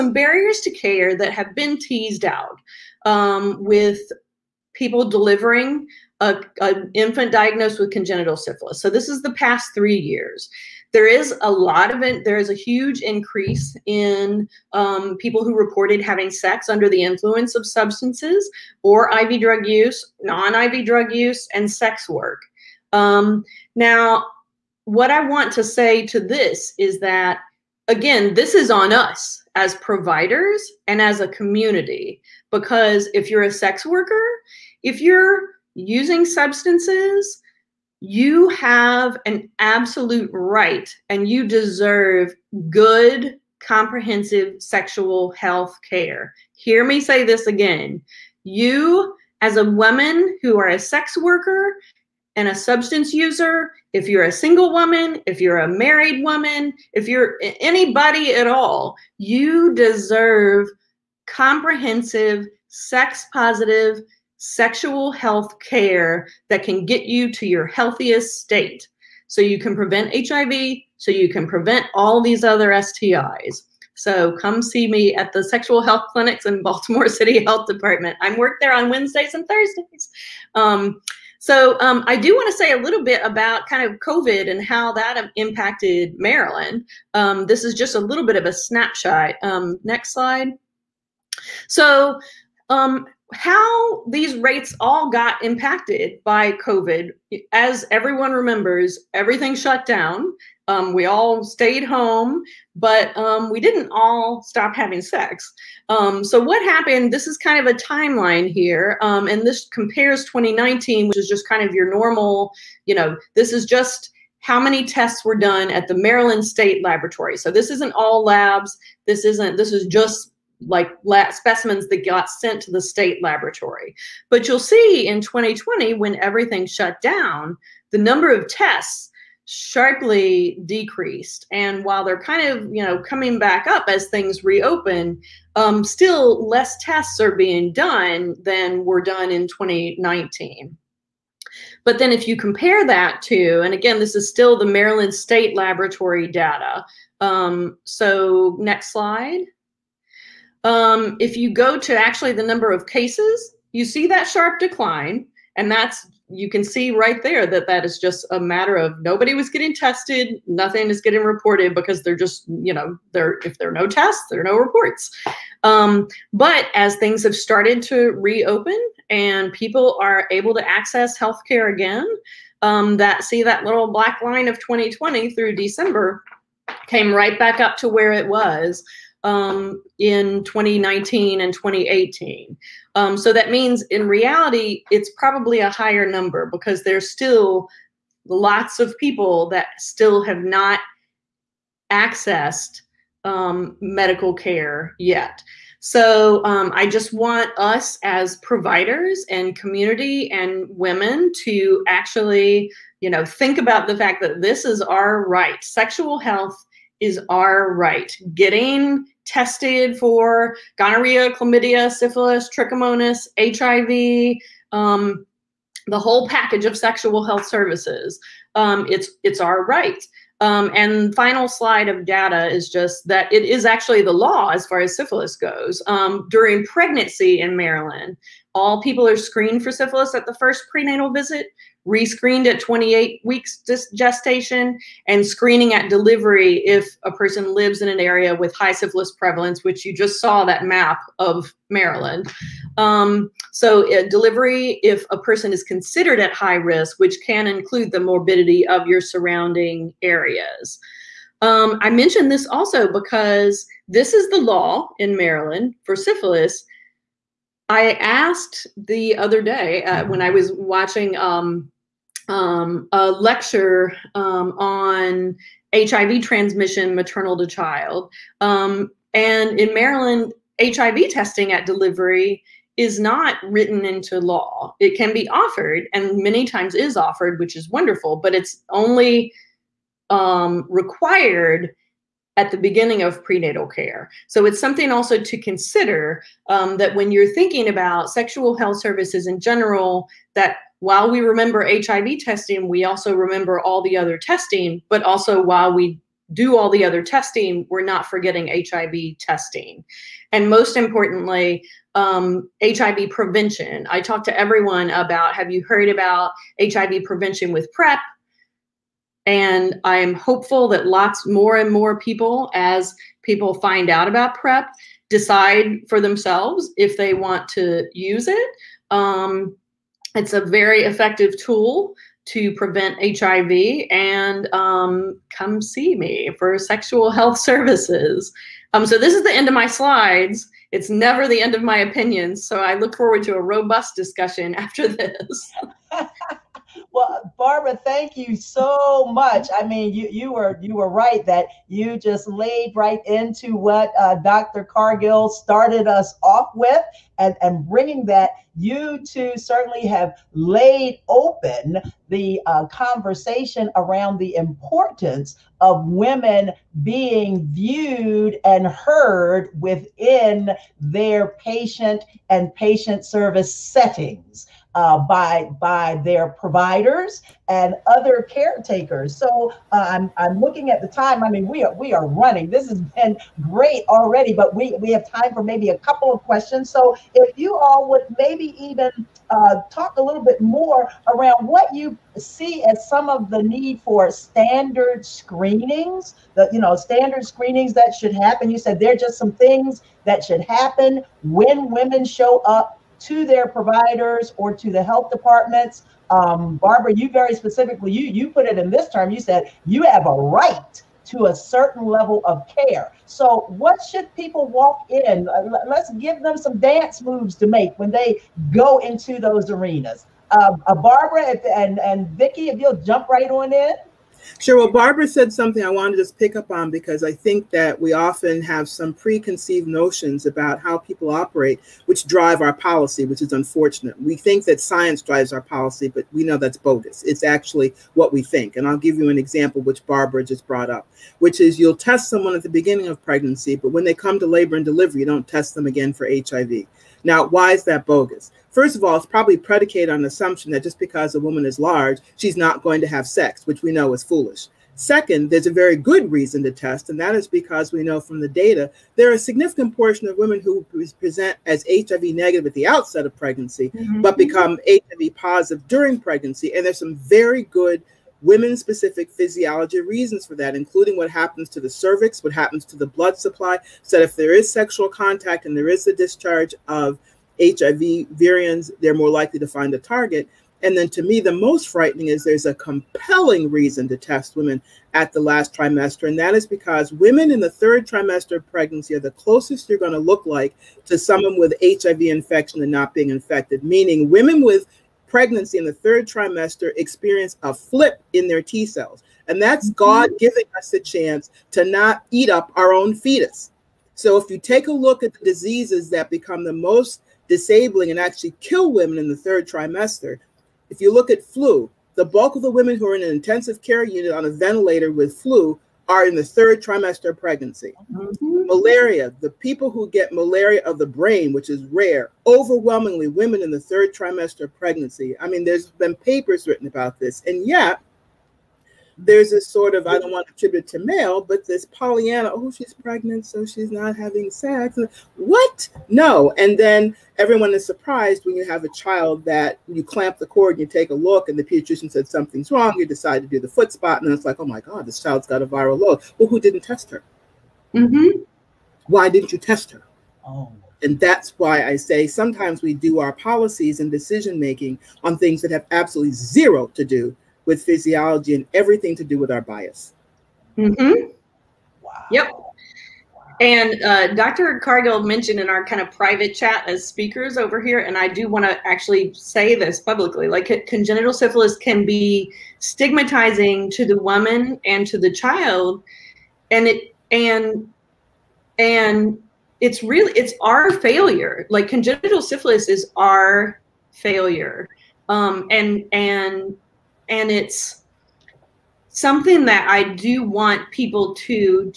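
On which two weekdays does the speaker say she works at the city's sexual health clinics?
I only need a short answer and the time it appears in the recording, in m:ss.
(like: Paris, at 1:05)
Wednesdays and Thursdays, at 1:18.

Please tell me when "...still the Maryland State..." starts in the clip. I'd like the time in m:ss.
2:24.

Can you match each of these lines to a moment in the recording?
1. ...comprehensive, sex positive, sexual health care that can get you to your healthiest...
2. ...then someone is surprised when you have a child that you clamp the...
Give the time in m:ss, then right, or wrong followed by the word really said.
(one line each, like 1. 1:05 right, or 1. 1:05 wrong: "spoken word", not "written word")
1. 1:01 right
2. 8:46 wrong: "everyone", not "someone".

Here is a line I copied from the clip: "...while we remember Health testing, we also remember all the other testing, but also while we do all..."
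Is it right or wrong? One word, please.
wrong.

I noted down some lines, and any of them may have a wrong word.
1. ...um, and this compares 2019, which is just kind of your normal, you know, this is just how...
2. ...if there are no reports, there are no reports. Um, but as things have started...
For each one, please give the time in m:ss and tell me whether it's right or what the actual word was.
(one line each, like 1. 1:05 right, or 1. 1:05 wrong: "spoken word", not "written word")
1. 1:49 right
2. 2:43 wrong: "tests", not "reports".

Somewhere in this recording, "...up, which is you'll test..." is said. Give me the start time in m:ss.
7:10.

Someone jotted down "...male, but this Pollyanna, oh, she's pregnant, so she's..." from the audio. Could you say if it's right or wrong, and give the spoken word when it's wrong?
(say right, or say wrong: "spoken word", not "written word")
right.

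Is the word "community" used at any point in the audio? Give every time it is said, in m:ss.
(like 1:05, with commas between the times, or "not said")
0:31, 3:19.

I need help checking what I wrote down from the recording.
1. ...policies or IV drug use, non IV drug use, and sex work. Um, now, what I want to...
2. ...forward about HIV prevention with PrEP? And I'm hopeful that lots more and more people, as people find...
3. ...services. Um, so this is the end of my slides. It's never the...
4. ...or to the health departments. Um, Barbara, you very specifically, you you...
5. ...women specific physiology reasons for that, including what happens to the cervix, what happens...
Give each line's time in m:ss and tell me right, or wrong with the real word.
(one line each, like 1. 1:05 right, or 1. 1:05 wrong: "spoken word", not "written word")
1. 0:17 wrong: "substances", not "policies"
2. 5:05 wrong: "heard", not "forward"
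3. 5:27 right
4. 6:34 right
5. 7:38 right.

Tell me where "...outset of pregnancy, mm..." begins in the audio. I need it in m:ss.
7:32.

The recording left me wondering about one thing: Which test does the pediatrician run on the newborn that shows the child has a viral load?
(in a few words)
Foot spot.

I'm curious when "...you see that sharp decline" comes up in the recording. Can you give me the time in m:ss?
2:33.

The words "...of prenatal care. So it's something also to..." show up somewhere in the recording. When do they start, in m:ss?
4:43.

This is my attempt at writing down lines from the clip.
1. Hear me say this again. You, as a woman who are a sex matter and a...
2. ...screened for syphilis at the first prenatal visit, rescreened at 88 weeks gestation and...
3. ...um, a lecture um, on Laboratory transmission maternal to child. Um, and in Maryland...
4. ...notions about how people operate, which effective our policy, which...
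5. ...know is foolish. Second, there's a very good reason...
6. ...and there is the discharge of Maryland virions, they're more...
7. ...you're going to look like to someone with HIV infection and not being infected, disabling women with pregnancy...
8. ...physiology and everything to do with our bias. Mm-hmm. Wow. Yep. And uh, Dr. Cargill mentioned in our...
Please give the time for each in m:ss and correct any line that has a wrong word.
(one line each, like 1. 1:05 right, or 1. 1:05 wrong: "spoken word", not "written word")
1. 0:46 wrong: "worker", not "matter"
2. 3:49 wrong: "28", not "88"
3. 4:22 wrong: "HIV", not "Laboratory"
4. 6:59 wrong: "drive", not "effective"
5. 7:23 right
6. 7:45 wrong: "HIV", not "Maryland"
7. 7:59 wrong: "meaning", not "disabling"
8. 9:07 right.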